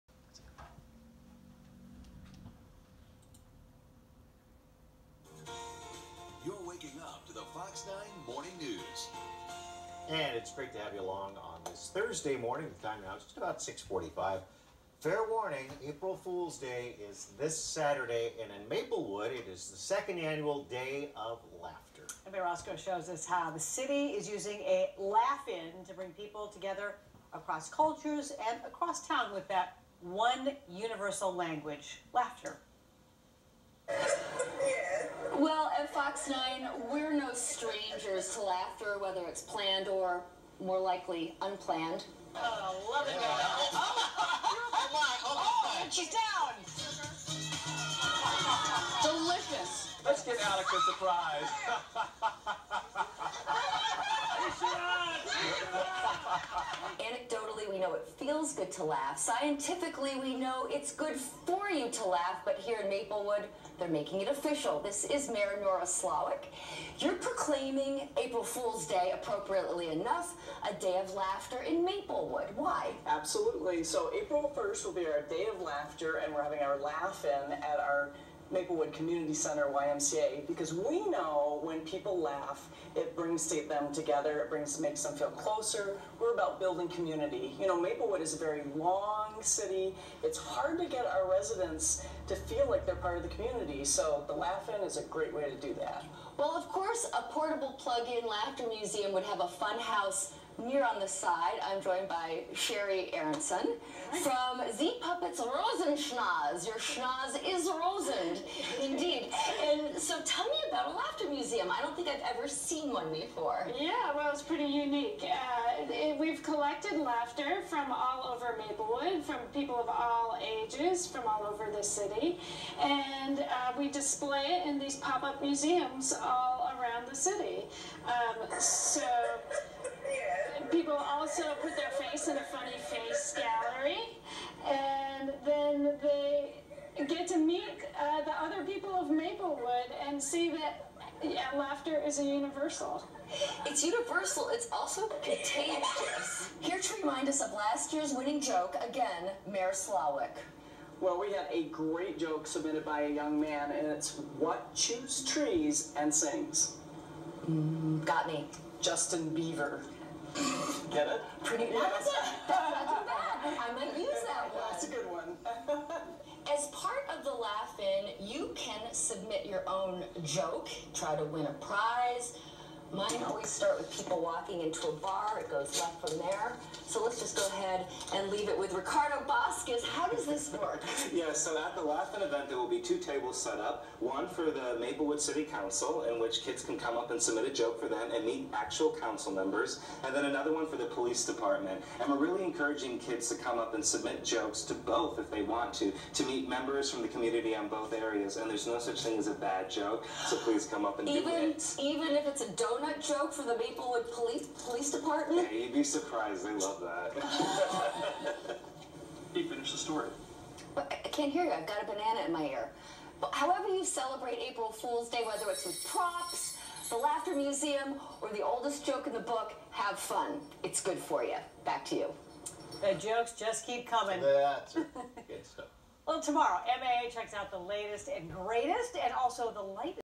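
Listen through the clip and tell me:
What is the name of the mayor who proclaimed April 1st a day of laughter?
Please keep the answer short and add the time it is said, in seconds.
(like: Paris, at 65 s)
Nora Slawik, at 65 s.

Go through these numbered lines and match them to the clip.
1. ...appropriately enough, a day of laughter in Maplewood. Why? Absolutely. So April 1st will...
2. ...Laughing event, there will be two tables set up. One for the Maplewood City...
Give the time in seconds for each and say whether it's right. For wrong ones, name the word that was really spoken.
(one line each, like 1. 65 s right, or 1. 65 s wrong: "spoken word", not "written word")
1. 69 s right
2. 181 s right.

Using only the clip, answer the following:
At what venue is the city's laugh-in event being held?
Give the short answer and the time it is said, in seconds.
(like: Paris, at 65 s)
Maplewood Community Center YMCA, at 78 s.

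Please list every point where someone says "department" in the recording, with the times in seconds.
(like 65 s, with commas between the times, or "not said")
191 s, 204 s.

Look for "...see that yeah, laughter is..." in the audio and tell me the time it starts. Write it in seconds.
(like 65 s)
140 s.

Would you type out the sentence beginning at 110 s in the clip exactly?
So tell me about a laughter museum.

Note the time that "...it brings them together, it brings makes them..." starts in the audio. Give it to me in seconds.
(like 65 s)
82 s.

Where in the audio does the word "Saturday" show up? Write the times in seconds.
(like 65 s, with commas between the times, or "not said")
17 s.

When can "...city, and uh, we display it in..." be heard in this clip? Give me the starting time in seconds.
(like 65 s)
121 s.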